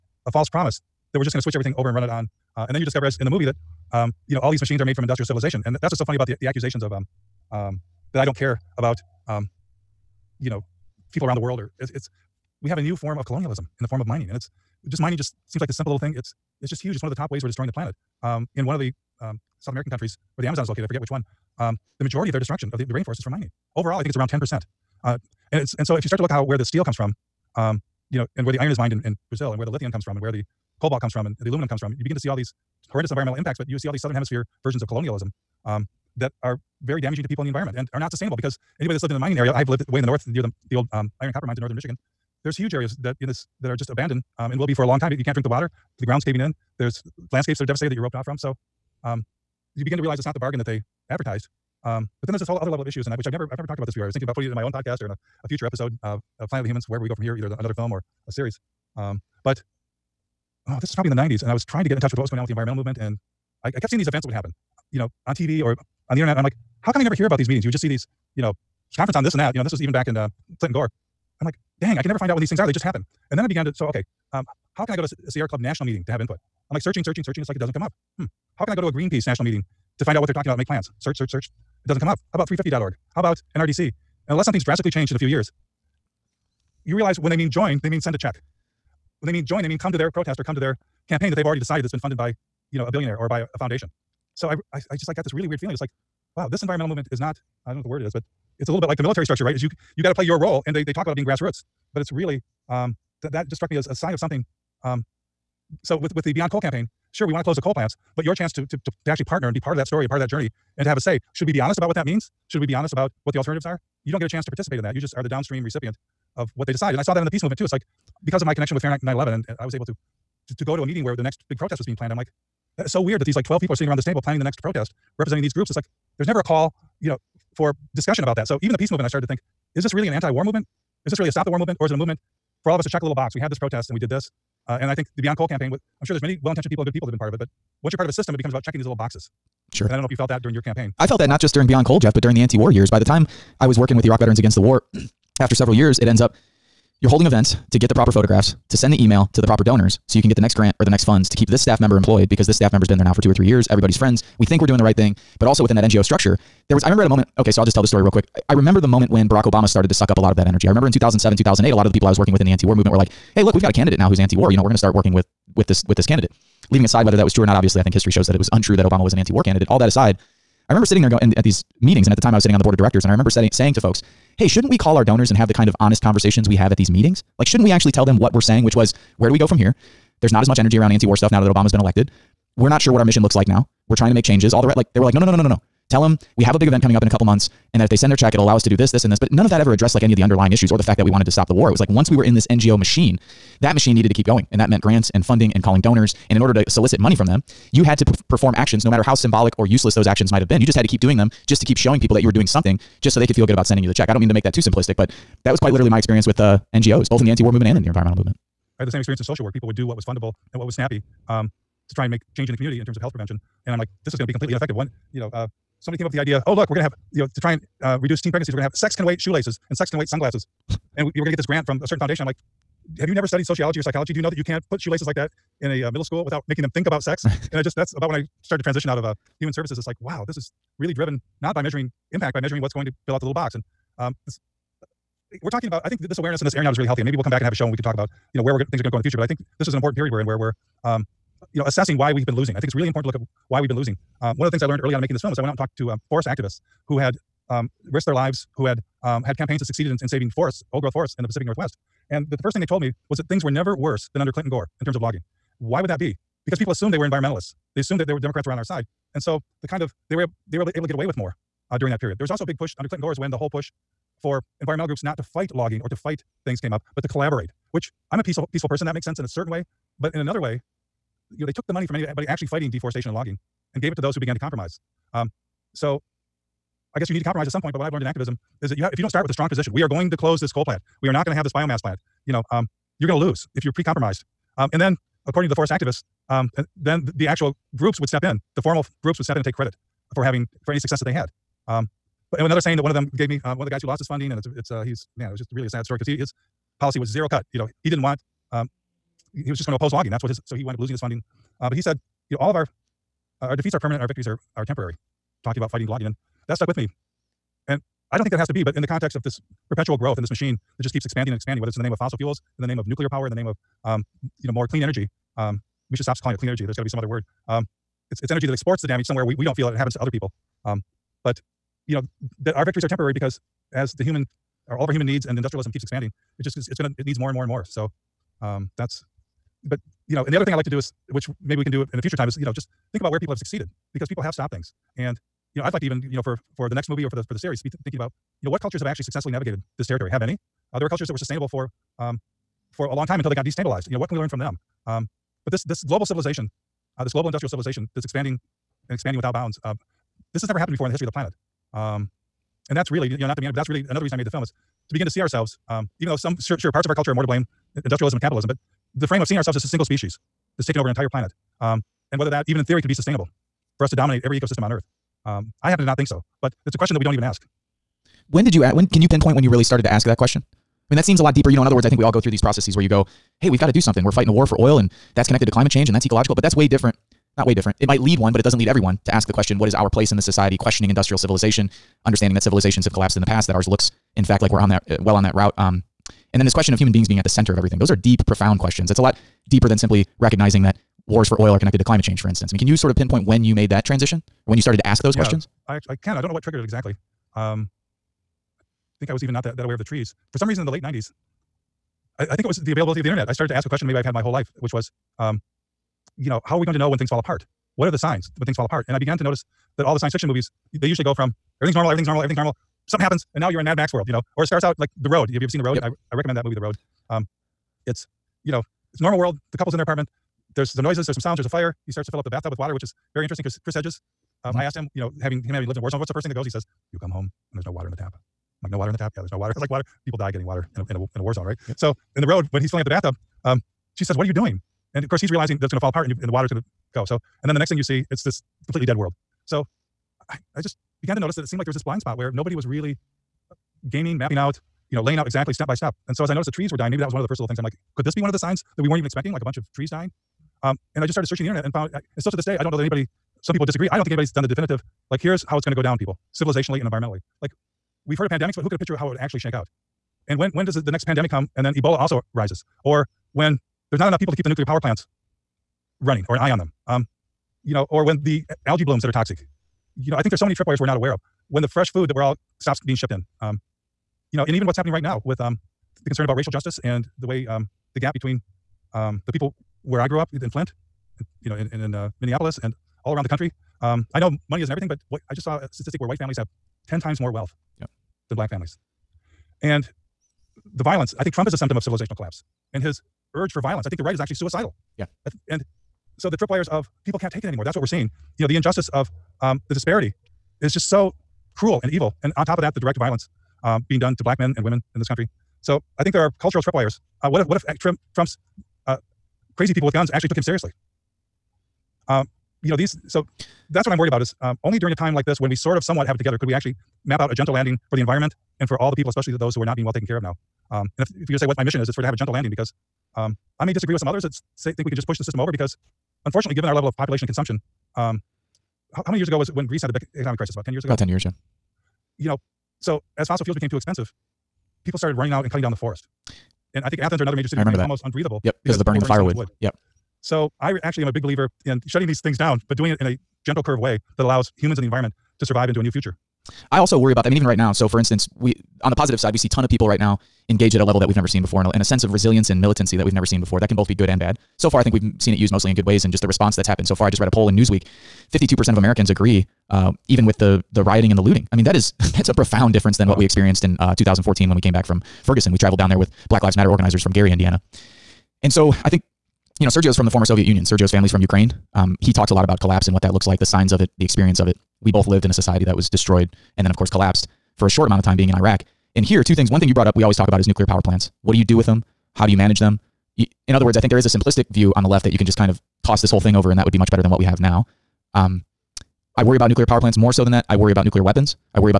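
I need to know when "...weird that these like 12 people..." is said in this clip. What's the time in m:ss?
2:03.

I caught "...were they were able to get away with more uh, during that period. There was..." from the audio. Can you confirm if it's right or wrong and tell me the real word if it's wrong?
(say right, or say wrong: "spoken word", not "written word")
right.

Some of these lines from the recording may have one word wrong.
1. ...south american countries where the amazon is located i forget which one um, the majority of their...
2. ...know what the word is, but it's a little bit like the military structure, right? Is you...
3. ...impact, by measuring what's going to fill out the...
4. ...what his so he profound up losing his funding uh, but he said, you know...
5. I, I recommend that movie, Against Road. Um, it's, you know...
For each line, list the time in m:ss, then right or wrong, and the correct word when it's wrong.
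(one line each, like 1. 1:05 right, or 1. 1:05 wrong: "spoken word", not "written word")
1. 0:19 right
2. 1:37 right
3. 3:52 right
4. 5:00 wrong: "wound", not "profound"
5. 6:55 wrong: "The", not "Against".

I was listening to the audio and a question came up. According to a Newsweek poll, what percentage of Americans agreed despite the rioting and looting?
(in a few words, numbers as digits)
52%.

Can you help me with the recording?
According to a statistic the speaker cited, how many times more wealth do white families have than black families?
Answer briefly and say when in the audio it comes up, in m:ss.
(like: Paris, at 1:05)
10 times, at 8:06.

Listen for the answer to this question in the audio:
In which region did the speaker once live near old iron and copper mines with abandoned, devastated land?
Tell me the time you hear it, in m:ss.
0:41.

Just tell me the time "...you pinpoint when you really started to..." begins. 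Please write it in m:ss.
6:09.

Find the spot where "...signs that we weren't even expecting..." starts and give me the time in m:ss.
7:28.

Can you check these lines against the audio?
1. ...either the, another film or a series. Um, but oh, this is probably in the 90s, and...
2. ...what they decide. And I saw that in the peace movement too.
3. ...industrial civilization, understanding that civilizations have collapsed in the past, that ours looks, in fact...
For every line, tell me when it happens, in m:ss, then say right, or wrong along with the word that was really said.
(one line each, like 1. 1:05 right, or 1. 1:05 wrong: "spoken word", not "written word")
1. 0:57 right
2. 1:56 right
3. 6:20 right.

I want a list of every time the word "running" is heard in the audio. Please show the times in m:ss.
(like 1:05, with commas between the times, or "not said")
7:46, 8:55.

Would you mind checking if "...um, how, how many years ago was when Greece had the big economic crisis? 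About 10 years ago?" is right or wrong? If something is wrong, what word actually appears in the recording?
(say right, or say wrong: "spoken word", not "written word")
right.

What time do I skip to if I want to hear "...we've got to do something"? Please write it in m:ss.
6:13.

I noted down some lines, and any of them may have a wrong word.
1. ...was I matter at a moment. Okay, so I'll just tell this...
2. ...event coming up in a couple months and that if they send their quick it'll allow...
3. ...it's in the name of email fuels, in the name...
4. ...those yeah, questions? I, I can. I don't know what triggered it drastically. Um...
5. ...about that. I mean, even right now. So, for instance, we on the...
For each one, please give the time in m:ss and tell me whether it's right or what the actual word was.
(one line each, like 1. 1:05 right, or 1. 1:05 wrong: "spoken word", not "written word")
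1. 2:36 wrong: "remember", not "matter"
2. 3:06 wrong: "check", not "quick"
3. 5:11 wrong: "fossil", not "email"
4. 6:35 wrong: "exactly", not "drastically"
5. 9:07 right.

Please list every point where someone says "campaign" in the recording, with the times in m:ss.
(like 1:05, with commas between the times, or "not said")
1:31, 1:46, 2:15, 2:20, 4:09.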